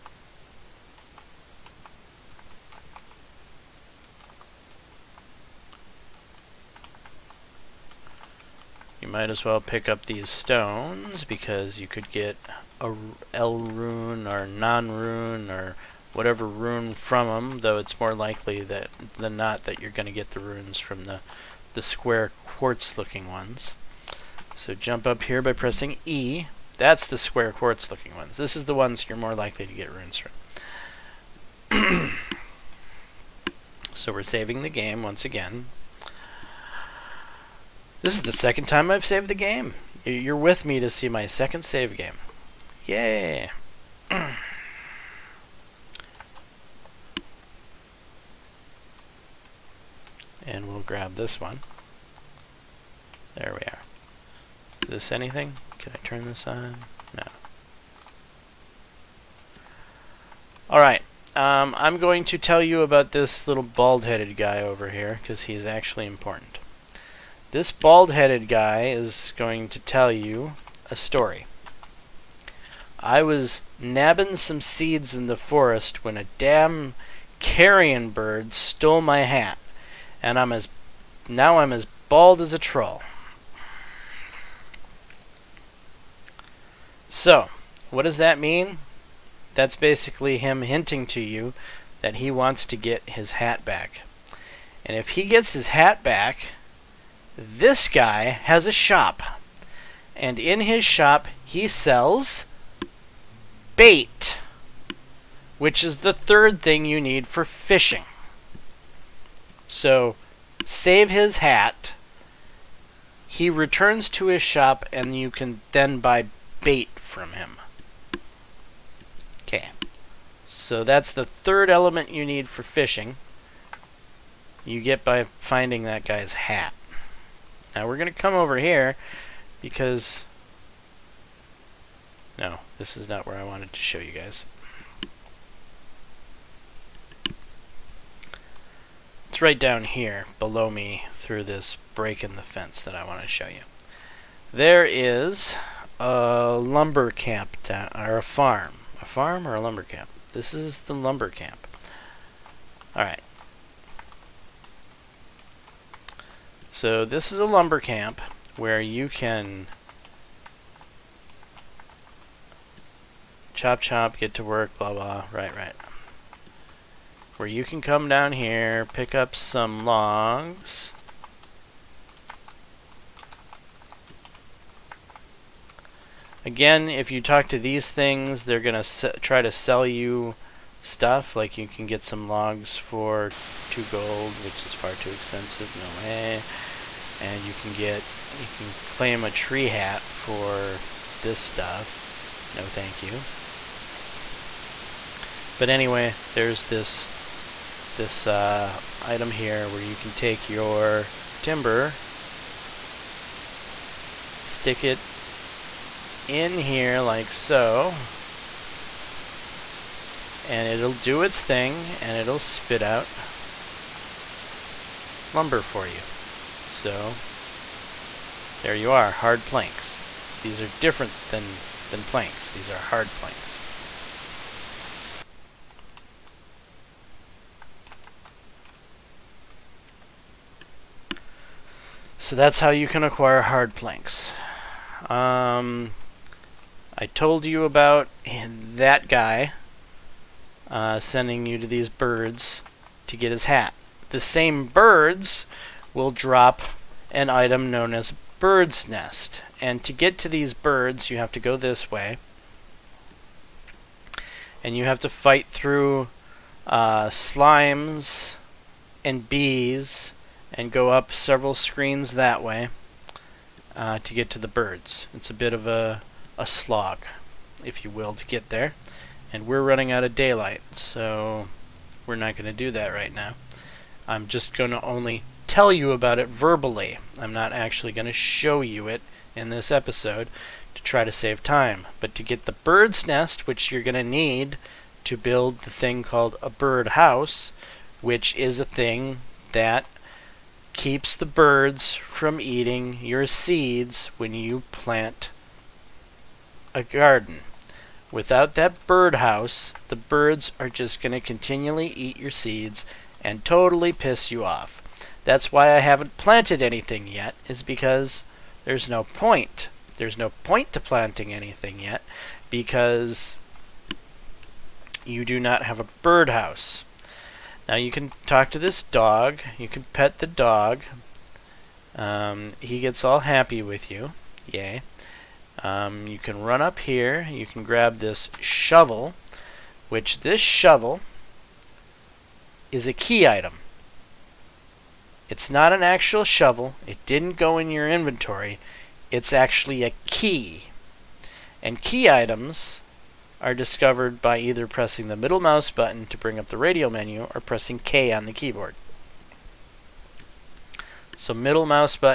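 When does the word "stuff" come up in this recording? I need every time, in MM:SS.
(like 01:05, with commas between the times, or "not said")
03:00, 03:11.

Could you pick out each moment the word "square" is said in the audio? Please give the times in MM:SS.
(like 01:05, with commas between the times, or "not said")
00:21, 00:27.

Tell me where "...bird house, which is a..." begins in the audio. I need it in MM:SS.
04:46.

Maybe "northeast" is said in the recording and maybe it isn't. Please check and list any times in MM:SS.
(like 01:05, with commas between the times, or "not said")
not said.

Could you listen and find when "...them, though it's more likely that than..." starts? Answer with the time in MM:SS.
00:17.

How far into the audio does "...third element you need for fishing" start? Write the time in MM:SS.
02:01.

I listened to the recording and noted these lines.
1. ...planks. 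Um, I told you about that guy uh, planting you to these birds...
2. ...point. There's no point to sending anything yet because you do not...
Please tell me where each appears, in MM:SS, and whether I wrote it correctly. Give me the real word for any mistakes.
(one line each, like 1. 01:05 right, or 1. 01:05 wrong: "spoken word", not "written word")
1. 03:53 wrong: "sending", not "planting"
2. 05:09 wrong: "planting", not "sending".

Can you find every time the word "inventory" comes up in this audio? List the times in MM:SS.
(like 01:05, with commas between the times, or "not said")
05:37.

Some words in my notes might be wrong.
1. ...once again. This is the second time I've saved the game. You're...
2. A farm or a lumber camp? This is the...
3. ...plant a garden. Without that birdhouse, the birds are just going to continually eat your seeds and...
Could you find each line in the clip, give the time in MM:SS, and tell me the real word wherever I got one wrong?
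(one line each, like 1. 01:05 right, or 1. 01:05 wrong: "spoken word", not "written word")
1. 00:35 right
2. 02:29 right
3. 04:54 right.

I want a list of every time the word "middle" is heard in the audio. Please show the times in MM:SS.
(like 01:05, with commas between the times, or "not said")
05:45, 05:51.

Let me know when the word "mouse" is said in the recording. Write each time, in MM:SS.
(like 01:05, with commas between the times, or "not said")
05:45.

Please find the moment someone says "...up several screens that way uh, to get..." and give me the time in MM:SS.
04:20.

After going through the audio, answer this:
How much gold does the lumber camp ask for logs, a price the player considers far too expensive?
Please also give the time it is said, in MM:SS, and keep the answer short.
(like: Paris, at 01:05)
2 gold, at 03:03.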